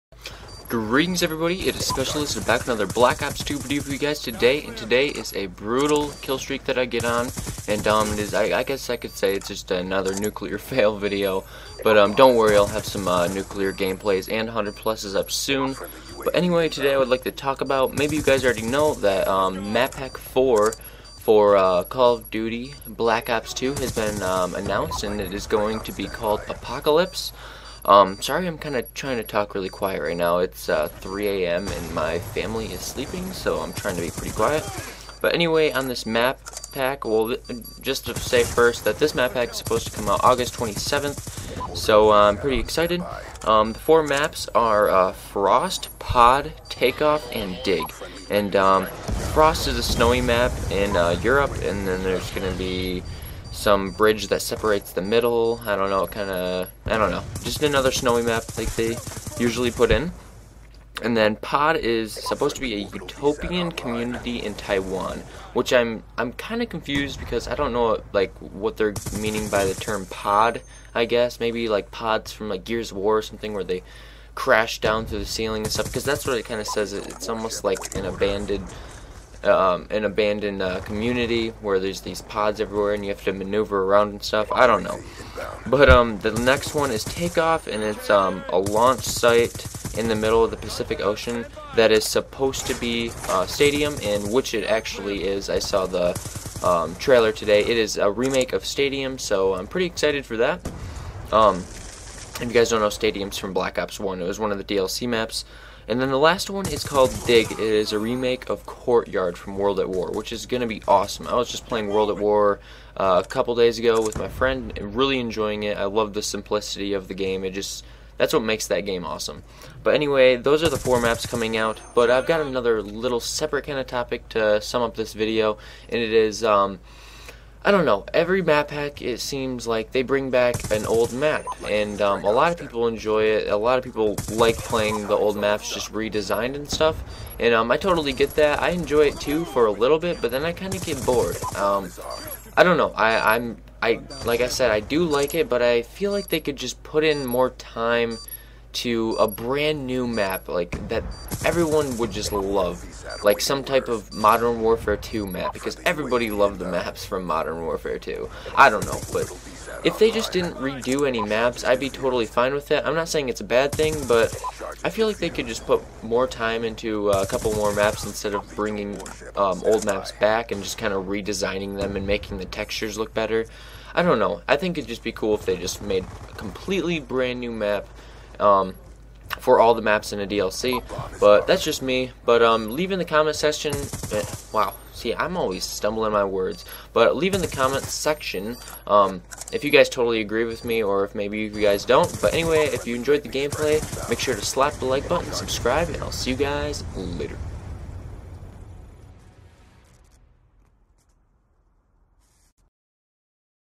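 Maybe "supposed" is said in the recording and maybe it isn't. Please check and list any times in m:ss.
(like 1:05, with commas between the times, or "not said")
0:39, 1:02, 1:32.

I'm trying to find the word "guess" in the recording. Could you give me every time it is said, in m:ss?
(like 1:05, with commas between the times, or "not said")
0:08, 1:11.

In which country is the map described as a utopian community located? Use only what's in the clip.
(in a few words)
Taiwan.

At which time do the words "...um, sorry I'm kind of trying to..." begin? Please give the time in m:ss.
0:27.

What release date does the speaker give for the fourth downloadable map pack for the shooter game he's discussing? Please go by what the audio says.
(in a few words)
August 27th.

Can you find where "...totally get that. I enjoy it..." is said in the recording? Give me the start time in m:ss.
2:17.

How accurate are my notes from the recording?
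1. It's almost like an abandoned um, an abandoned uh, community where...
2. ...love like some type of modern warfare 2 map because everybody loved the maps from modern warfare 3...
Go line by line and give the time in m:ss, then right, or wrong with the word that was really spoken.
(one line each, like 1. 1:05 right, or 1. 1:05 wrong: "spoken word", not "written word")
1. 1:16 right
2. 2:32 wrong: "2", not "3".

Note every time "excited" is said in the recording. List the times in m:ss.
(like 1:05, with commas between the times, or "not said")
0:42, 1:39.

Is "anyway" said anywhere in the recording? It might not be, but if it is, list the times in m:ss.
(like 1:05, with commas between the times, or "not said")
0:16, 0:35, 1:59, 3:12.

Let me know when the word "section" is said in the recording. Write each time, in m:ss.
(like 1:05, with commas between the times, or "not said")
3:03, 3:07.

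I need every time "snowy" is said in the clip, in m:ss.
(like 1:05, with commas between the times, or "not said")
0:49, 0:57.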